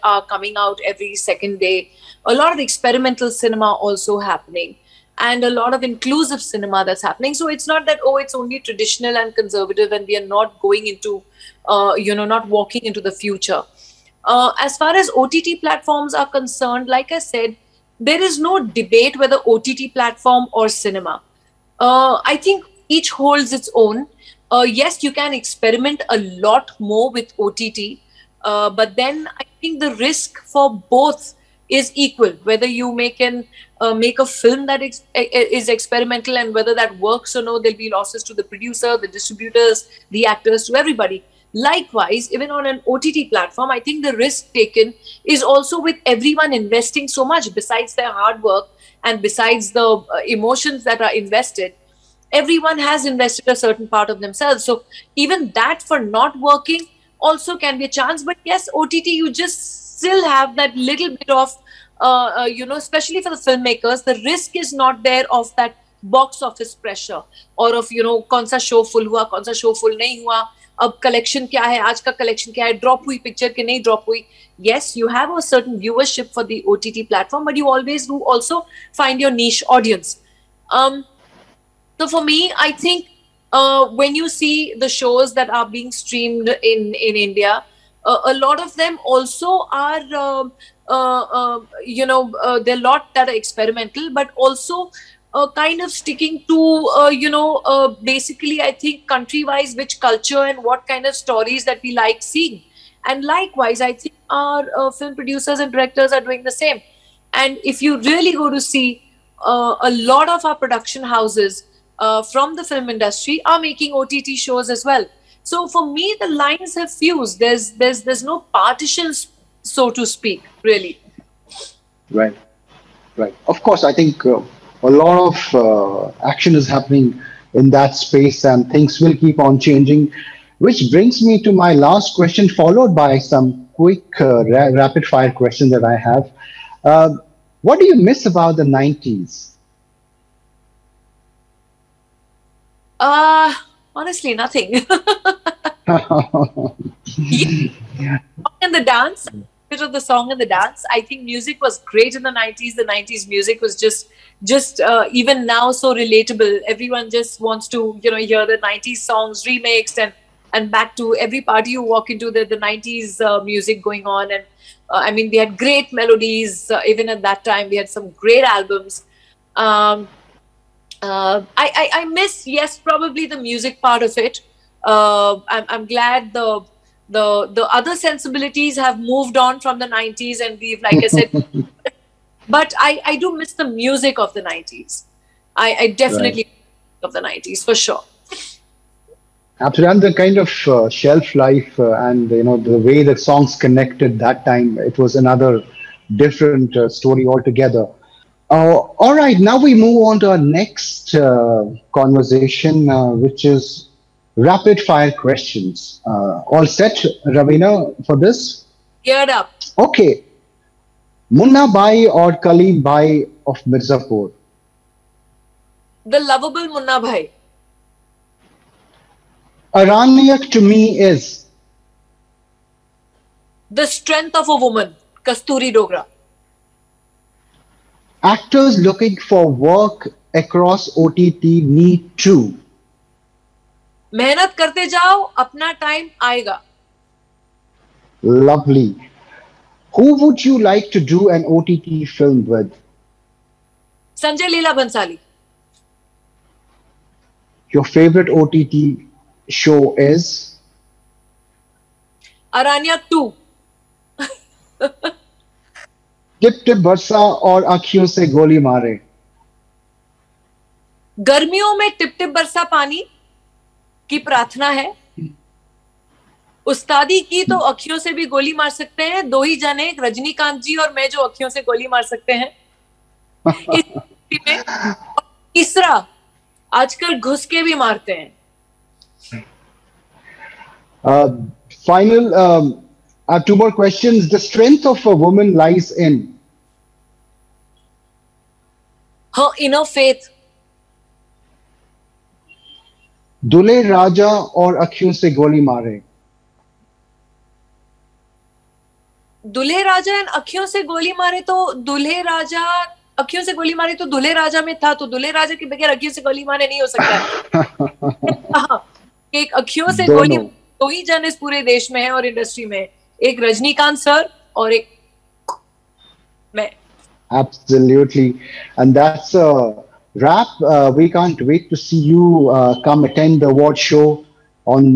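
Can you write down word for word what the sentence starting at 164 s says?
And uh, I mean we had great melodies uh, even at that time.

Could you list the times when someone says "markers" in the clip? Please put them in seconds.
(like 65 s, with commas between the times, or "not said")
not said.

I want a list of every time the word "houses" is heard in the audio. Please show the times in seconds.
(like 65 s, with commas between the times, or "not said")
111 s.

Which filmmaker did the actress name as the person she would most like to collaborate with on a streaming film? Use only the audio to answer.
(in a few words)
Sanjay Leela Bansali.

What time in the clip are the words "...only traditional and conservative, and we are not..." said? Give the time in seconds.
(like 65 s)
8 s.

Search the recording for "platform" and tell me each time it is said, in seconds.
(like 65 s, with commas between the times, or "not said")
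15 s, 19 s, 43 s.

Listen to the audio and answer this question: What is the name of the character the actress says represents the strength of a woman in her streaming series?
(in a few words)
Kasturi Dogra.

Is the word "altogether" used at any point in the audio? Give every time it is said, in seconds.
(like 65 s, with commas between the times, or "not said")
197 s.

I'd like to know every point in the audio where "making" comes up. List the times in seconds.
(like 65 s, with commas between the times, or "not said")
113 s.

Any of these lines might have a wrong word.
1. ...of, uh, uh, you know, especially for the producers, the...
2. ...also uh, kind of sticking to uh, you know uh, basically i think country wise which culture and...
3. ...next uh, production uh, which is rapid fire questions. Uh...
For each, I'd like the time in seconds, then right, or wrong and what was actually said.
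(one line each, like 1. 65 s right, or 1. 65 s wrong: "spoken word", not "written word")
1. 61 s wrong: "filmmakers", not "producers"
2. 94 s right
3. 200 s wrong: "conversation", not "production".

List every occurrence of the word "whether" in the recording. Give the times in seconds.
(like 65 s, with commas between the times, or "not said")
19 s, 32 s, 36 s.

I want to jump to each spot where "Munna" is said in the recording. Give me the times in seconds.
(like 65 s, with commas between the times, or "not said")
211 s, 216 s.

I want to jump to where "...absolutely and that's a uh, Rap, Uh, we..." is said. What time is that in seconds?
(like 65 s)
317 s.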